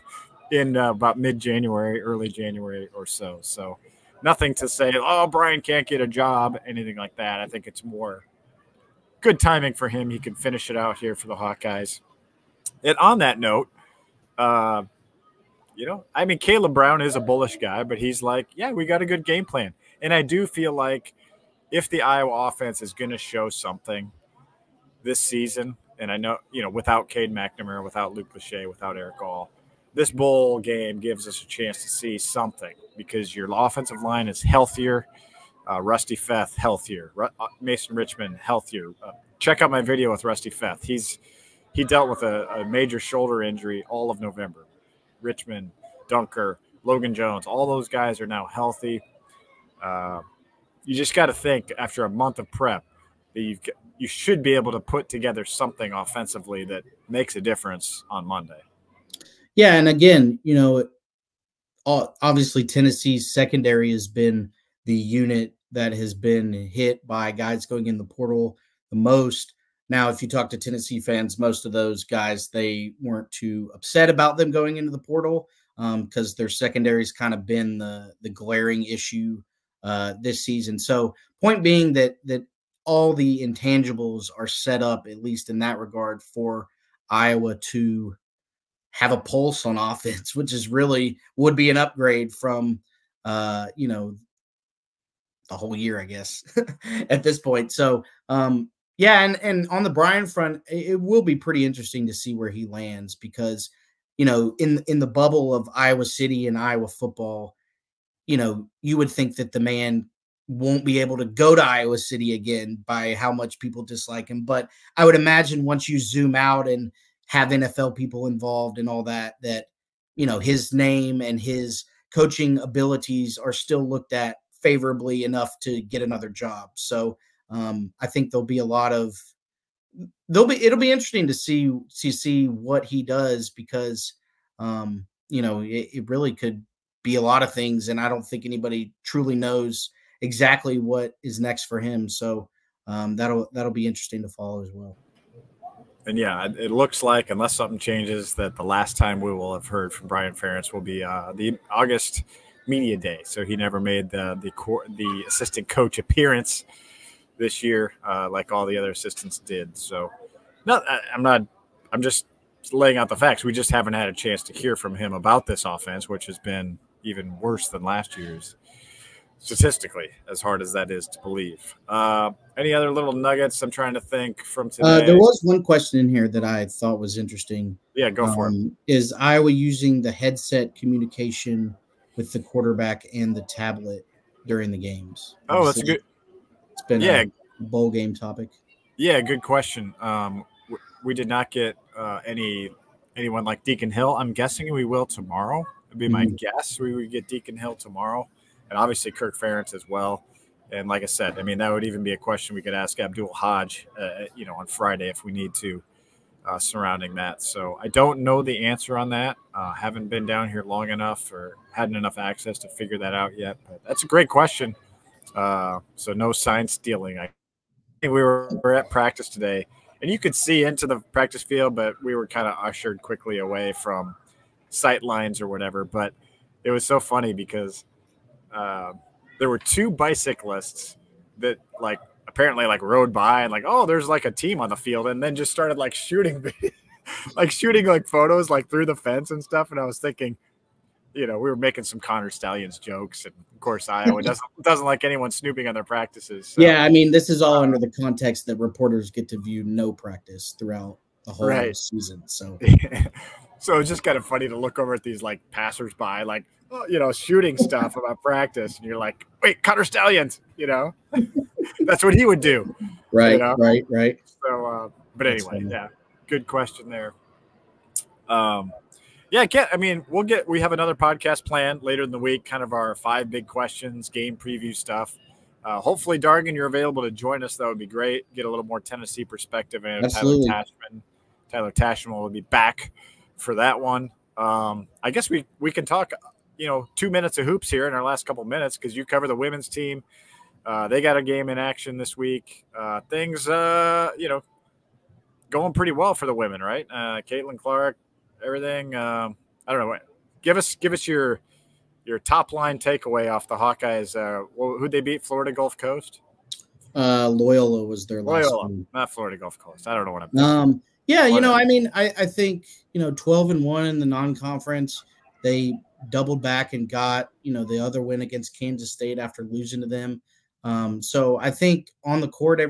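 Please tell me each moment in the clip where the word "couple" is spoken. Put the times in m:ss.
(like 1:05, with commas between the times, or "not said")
4:48.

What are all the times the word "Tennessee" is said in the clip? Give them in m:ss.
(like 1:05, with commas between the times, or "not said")
1:02, 1:10, 4:38.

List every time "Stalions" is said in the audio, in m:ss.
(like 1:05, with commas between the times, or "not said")
4:02, 4:19.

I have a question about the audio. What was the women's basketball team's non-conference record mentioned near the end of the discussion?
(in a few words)
12-1.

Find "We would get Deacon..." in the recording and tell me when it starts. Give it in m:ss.
3:16.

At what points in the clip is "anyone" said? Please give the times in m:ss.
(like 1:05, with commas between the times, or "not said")
3:13, 4:05.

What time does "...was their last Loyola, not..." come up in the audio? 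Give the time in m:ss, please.
5:07.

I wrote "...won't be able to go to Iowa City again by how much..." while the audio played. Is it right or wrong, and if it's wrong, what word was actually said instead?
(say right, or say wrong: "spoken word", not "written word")
right.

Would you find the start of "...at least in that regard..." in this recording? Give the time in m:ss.
1:25.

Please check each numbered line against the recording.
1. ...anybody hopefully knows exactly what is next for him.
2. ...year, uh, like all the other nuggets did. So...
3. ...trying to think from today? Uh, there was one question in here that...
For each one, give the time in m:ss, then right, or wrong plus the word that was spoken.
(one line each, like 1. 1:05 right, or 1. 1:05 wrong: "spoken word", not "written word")
1. 2:18 wrong: "truly", not "hopefully"
2. 2:37 wrong: "assistants", not "nuggets"
3. 2:53 right.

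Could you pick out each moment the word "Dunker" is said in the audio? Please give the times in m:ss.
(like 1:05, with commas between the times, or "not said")
0:46.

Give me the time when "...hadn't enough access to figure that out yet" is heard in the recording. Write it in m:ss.
3:31.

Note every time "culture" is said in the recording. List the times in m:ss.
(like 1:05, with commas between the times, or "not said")
not said.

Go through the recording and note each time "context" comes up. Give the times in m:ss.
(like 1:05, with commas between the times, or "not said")
4:07.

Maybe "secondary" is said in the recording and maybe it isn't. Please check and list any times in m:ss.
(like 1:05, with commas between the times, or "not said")
1:03, 1:16.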